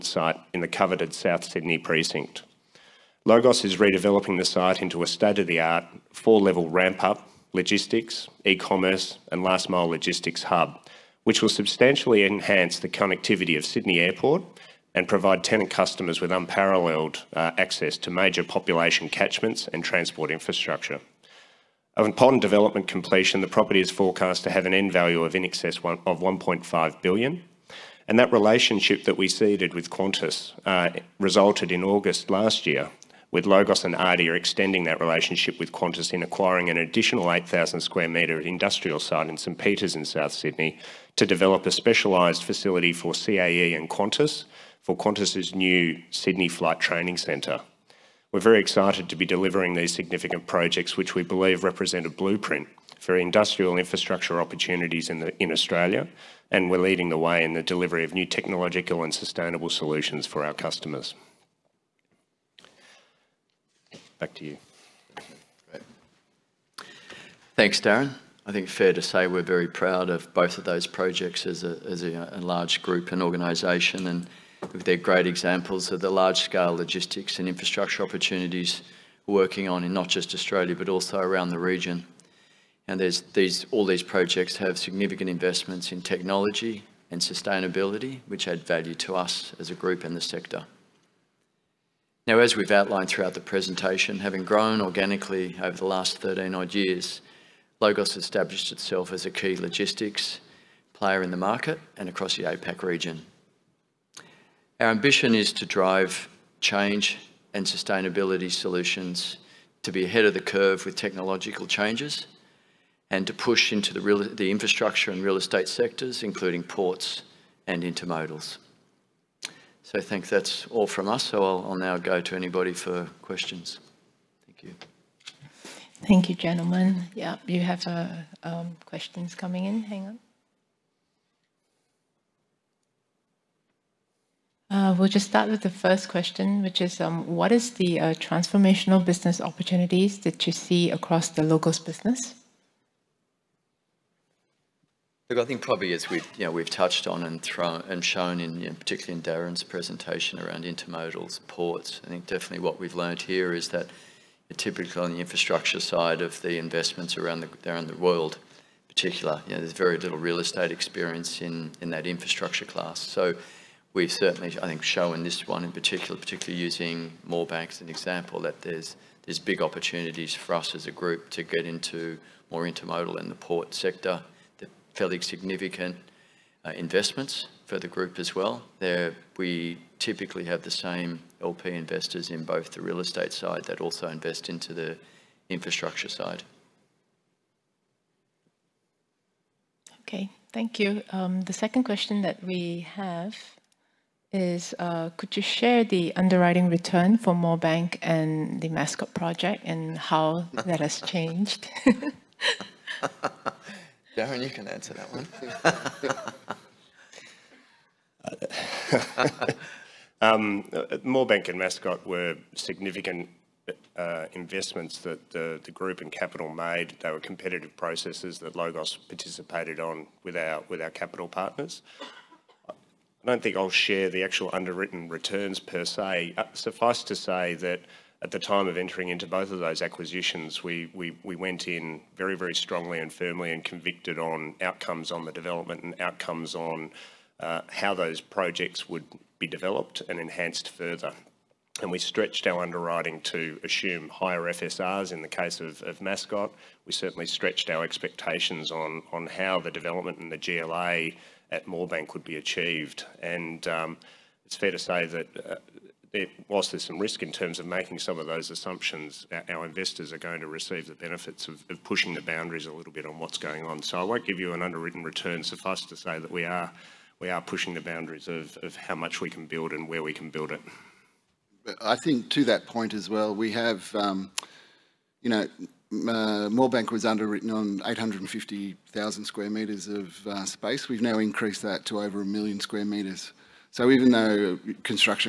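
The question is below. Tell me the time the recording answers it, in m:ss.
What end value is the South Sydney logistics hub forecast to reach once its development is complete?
0:25.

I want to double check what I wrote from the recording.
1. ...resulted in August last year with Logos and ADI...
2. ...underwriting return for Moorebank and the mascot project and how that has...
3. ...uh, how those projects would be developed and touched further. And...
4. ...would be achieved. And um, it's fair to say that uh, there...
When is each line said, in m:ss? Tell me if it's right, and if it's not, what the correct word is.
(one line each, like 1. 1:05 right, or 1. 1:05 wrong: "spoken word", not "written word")
1. 0:31 right
2. 3:16 right
3. 3:57 wrong: "enhanced", not "touched"
4. 4:12 right.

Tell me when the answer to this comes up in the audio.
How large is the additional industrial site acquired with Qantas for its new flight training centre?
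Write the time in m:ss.
0:37.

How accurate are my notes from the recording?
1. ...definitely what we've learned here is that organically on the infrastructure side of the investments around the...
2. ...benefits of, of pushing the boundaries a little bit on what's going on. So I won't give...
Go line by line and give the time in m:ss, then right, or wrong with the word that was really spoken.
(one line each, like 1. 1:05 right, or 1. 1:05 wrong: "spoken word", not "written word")
1. 2:32 wrong: "typically", not "organically"
2. 4:20 right.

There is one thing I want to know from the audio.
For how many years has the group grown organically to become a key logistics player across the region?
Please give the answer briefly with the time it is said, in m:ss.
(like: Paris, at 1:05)
13, at 1:36.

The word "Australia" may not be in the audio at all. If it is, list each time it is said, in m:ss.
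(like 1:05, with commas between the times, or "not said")
0:55, 1:20.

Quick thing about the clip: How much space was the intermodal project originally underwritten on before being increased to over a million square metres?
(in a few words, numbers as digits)
850,000 square metres.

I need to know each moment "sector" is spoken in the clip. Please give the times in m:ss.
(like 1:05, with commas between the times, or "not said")
1:30, 1:55, 2:53.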